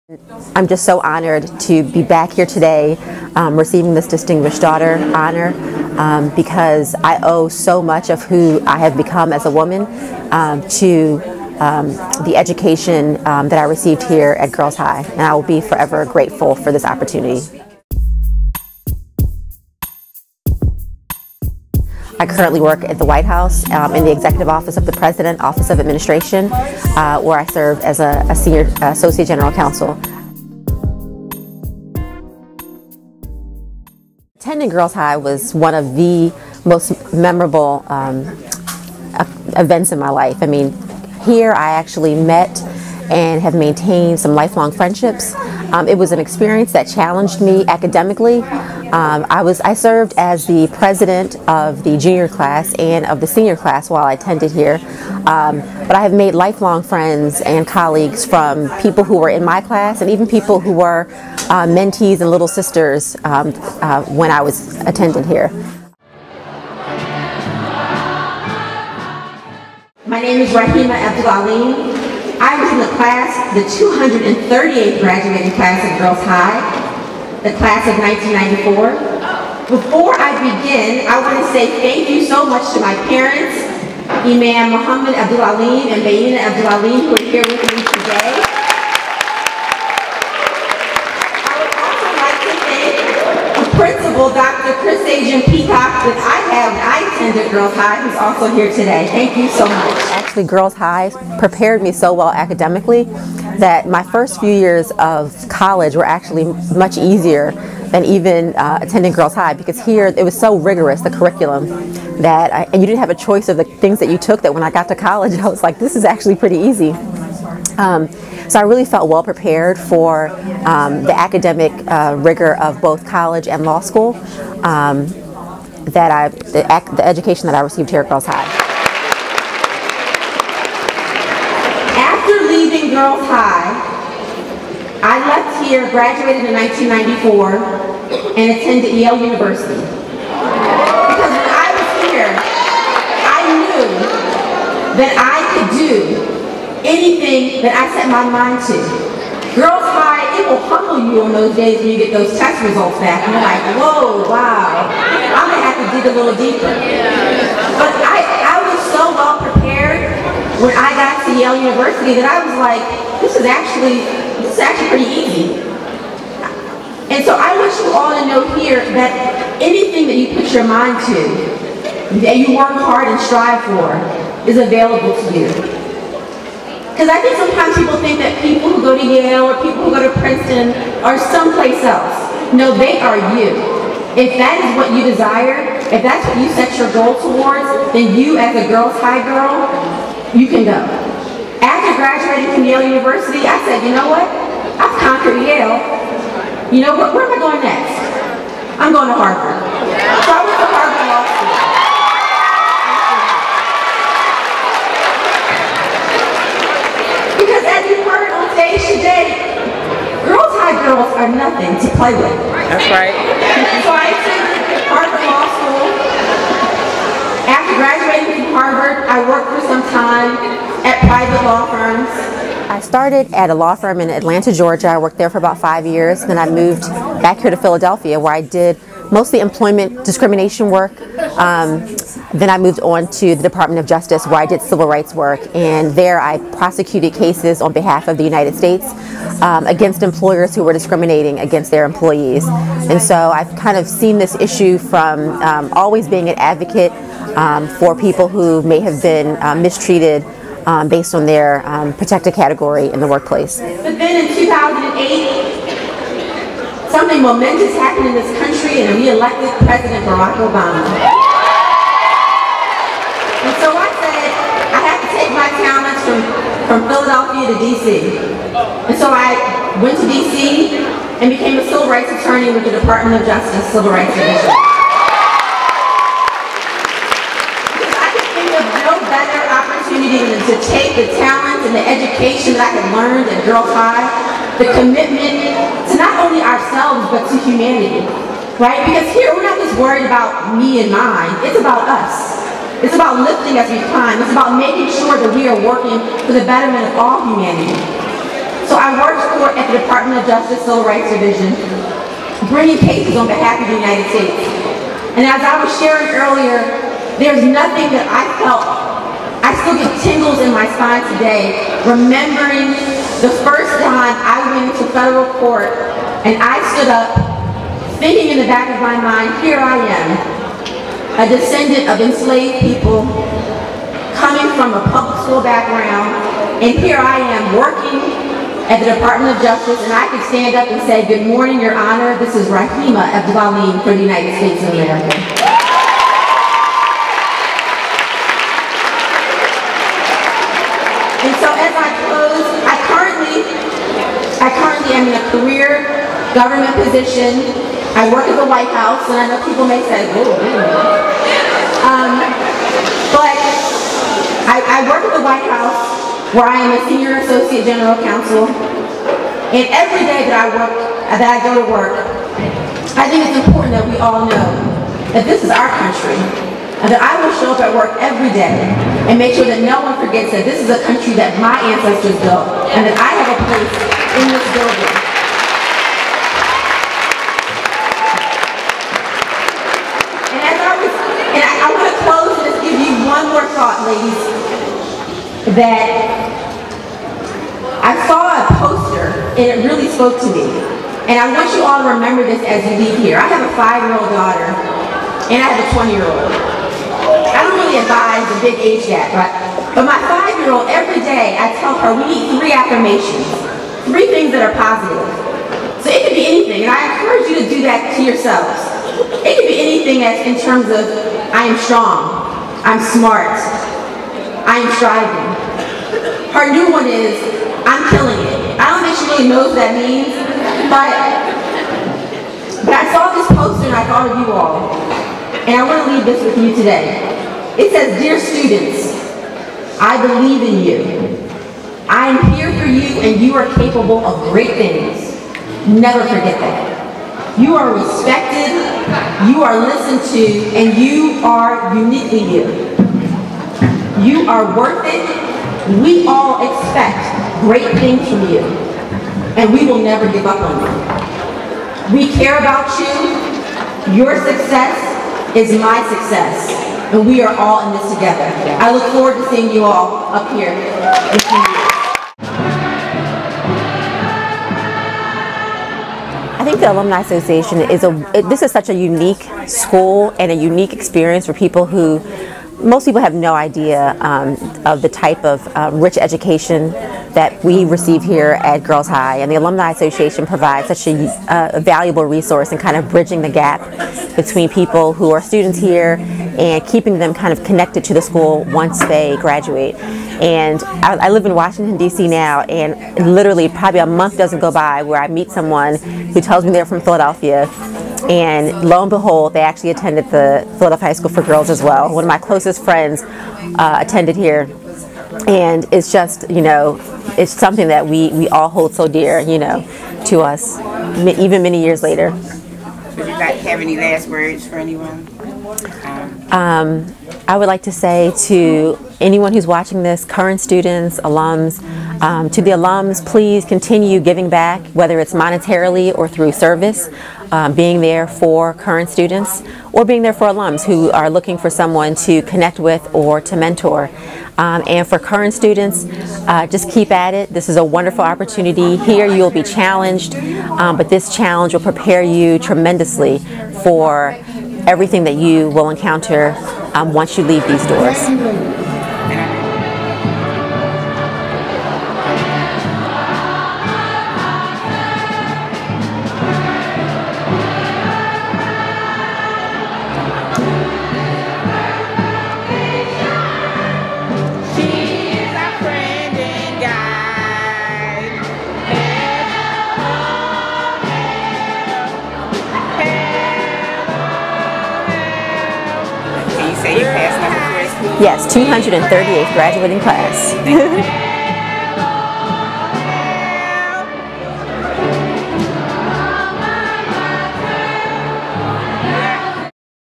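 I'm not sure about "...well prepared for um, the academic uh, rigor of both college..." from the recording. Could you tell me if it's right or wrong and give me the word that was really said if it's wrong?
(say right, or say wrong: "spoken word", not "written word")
right.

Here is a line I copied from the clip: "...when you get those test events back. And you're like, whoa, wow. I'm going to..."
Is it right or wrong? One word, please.
wrong.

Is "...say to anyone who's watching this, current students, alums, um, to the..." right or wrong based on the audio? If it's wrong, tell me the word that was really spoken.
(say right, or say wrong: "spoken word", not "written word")
right.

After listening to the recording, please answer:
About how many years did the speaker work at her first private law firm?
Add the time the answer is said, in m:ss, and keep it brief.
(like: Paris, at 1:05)
5, at 3:45.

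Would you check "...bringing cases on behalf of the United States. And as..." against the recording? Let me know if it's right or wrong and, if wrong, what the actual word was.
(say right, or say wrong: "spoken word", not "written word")
right.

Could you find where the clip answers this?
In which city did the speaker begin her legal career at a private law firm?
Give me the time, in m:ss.
3:44.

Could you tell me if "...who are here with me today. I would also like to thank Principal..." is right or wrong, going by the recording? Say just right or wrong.
right.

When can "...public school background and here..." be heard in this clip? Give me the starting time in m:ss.
5:24.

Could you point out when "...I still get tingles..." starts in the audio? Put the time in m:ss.
5:09.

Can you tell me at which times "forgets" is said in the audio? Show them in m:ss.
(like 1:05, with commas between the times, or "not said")
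6:09, 7:16.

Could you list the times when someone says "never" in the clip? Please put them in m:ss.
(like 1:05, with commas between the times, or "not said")
7:15, 7:29.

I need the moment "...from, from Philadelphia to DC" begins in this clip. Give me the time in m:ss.
4:26.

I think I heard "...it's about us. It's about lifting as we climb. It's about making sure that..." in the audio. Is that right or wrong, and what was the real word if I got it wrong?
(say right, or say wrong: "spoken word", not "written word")
right.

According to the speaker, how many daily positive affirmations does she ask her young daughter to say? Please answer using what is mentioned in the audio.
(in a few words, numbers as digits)
3.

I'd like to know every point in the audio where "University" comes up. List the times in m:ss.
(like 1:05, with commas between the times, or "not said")
2:19, 2:41, 3:12.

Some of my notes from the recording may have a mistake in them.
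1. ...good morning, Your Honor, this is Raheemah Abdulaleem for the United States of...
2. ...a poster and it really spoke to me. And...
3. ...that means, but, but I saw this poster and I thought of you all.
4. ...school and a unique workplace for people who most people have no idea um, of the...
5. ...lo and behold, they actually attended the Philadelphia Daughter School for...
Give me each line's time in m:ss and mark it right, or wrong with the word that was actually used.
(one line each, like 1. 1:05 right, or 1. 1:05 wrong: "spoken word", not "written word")
1. 5:31 right
2. 6:28 right
3. 6:59 right
4. 7:49 wrong: "experience", not "workplace"
5. 8:18 wrong: "High", not "Daughter".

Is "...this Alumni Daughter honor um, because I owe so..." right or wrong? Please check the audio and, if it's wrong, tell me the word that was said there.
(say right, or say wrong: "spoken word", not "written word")
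wrong: "Distinguished", not "Alumni".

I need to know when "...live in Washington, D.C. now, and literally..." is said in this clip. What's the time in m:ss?
8:11.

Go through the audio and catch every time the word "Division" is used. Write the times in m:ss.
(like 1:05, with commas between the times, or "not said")
4:34, 5:01.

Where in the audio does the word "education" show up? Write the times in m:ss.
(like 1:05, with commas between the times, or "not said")
0:12, 2:07, 4:41, 7:55.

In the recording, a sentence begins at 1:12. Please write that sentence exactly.
I was in the class, the 238th graduating class at Girls High the class of 1994.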